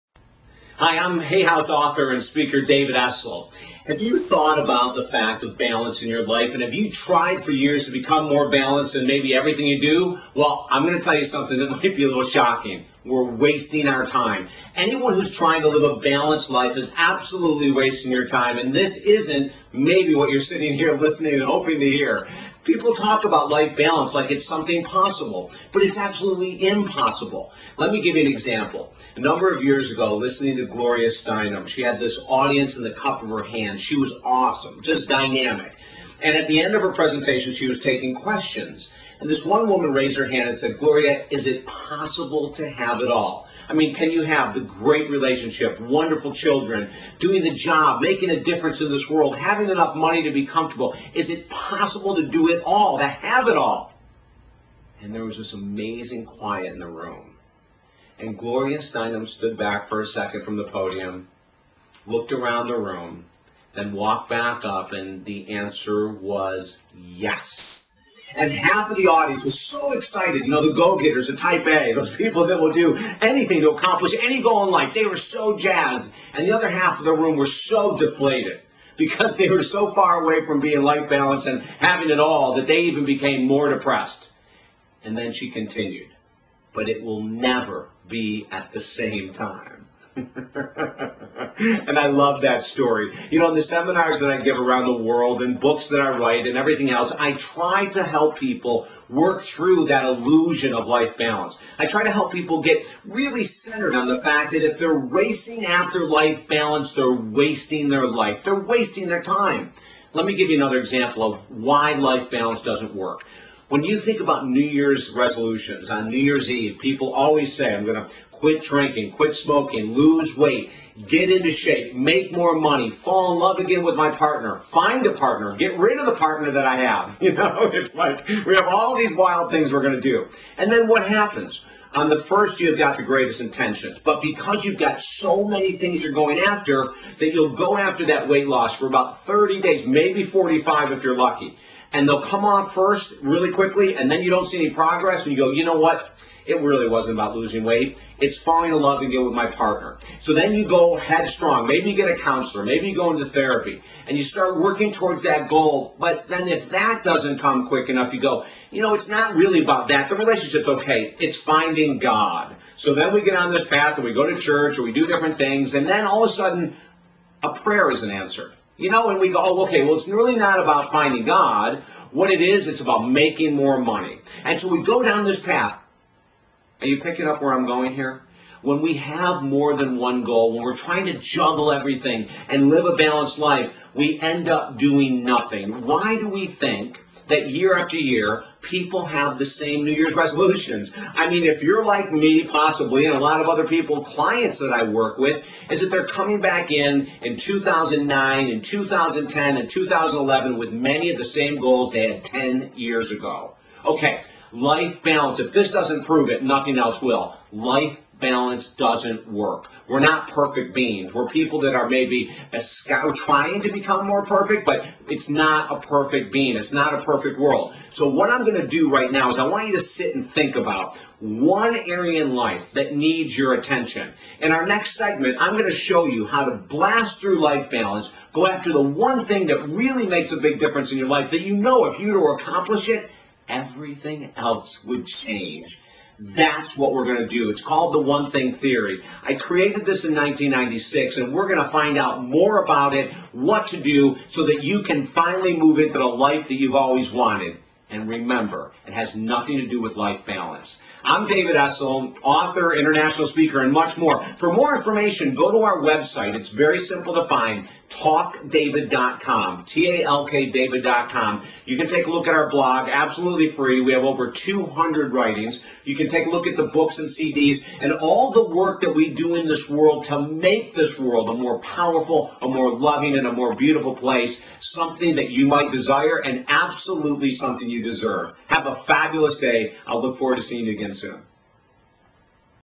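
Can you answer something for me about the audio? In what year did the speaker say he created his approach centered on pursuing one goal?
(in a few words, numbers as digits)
1996.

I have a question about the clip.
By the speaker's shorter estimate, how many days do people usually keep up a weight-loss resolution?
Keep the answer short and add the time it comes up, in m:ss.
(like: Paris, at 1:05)
30 days, at 2:19.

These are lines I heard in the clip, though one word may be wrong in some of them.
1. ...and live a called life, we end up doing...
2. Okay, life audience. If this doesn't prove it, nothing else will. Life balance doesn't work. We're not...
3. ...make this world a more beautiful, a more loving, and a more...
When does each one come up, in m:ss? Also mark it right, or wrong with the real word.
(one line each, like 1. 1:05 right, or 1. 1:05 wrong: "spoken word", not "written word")
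1. 3:02 wrong: "balanced", not "called"
2. 3:23 wrong: "balance", not "audience"
3. 4:30 wrong: "powerful", not "beautiful".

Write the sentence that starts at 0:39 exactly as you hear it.
And this one woman raised her hand and said, Gloria, is it possible to have it all?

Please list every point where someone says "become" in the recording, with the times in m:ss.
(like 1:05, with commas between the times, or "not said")
0:07, 3:33.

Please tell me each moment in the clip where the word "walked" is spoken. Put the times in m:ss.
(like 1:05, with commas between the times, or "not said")
1:03.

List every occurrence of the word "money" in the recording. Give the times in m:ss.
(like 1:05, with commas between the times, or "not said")
0:49, 2:02, 2:53.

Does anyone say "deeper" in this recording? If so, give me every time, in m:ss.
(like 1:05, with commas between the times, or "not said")
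not said.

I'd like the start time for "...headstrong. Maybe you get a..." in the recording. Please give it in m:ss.
2:30.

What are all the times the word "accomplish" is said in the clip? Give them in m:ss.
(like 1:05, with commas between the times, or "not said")
1:13, 3:52.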